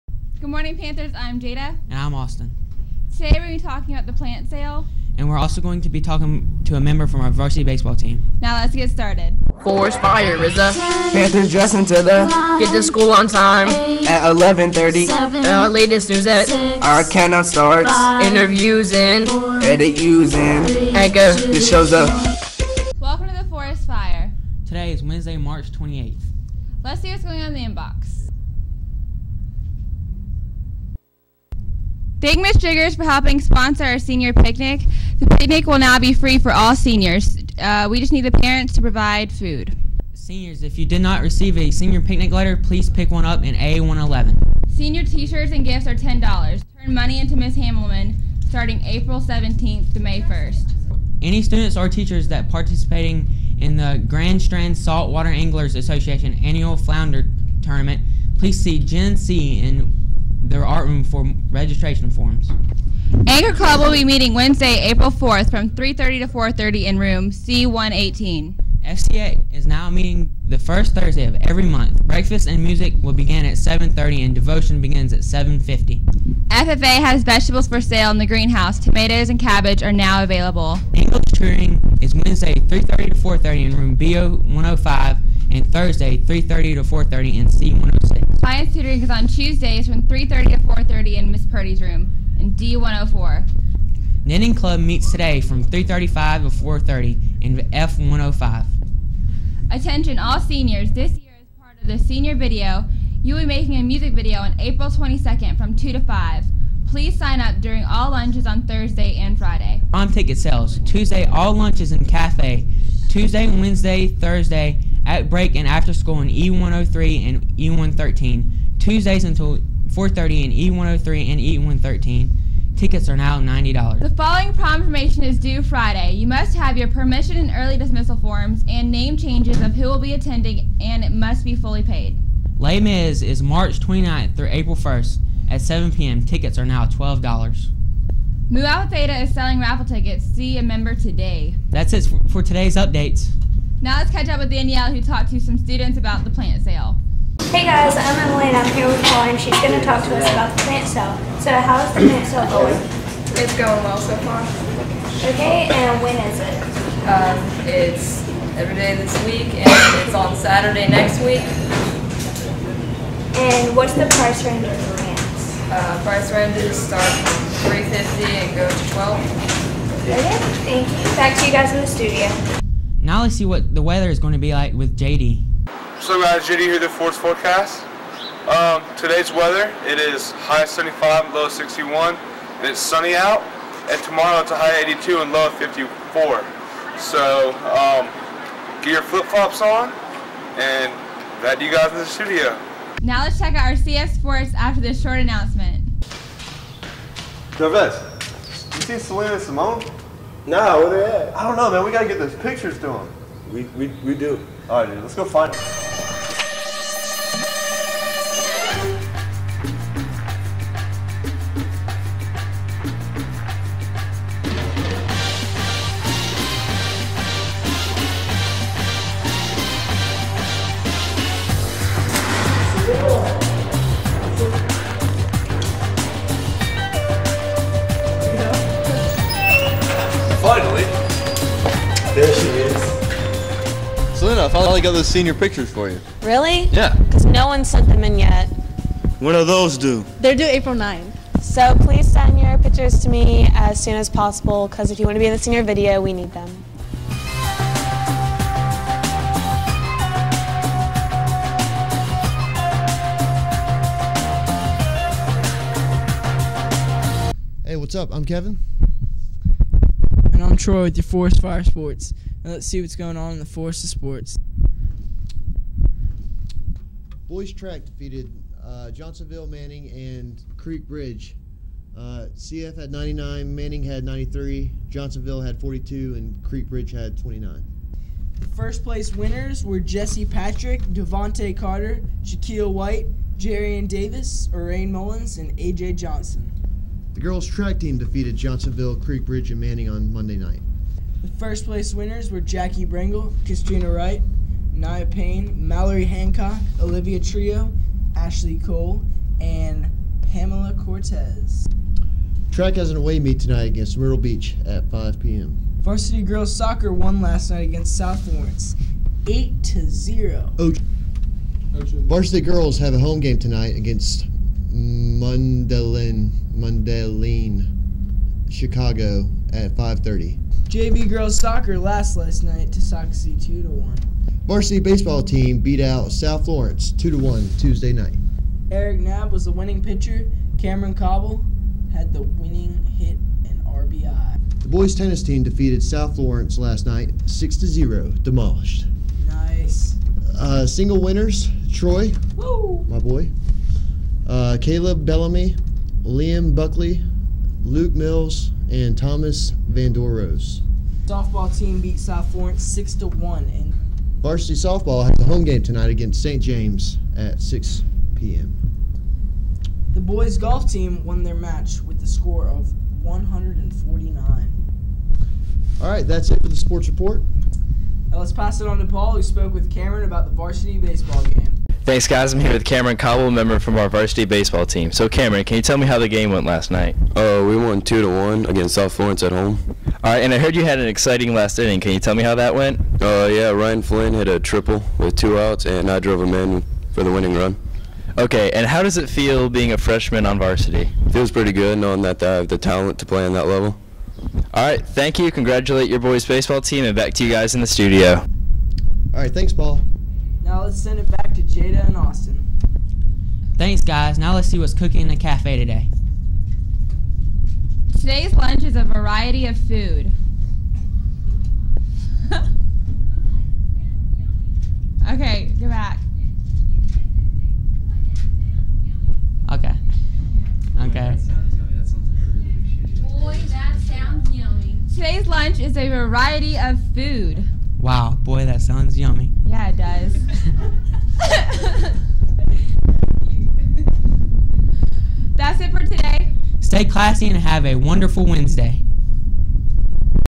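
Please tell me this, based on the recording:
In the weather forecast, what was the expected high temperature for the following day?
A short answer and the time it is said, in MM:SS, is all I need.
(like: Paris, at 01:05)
82, at 03:04.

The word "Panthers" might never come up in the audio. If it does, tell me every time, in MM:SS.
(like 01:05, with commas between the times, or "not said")
00:00, 00:11.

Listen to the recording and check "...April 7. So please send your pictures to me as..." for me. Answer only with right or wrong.
wrong.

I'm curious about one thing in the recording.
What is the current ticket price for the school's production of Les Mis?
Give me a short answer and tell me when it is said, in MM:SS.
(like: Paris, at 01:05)
$12, at 02:16.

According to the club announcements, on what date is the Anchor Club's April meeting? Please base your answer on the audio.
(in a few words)
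April 4th.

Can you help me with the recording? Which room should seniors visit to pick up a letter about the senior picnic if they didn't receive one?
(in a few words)
A111.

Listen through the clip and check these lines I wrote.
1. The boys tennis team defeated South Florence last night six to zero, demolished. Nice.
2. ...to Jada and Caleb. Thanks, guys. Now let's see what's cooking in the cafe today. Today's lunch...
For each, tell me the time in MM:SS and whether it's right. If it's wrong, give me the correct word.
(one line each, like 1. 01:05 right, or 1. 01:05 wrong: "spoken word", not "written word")
1. 05:34 right
2. 06:41 wrong: "Austin", not "Caleb".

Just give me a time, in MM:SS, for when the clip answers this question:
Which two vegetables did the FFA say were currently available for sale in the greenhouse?
01:18.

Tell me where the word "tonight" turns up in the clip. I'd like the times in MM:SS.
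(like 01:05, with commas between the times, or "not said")
05:03, 05:13, 05:55.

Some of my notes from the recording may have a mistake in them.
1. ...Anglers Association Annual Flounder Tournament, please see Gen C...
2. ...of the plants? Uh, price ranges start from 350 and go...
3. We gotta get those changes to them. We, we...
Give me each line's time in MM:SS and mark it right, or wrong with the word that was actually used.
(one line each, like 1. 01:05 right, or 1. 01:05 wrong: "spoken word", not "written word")
1. 00:55 right
2. 02:44 right
3. 03:21 wrong: "pictures", not "changes".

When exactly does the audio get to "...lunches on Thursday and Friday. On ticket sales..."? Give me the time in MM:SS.
01:48.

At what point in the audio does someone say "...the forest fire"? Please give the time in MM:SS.
00:23.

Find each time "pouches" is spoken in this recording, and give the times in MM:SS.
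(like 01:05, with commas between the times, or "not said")
not said.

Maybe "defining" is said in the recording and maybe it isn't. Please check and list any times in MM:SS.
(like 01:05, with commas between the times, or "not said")
not said.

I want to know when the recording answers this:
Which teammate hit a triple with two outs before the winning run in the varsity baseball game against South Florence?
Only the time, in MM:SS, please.
06:23.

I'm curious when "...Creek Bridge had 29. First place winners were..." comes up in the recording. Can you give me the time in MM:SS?
04:36.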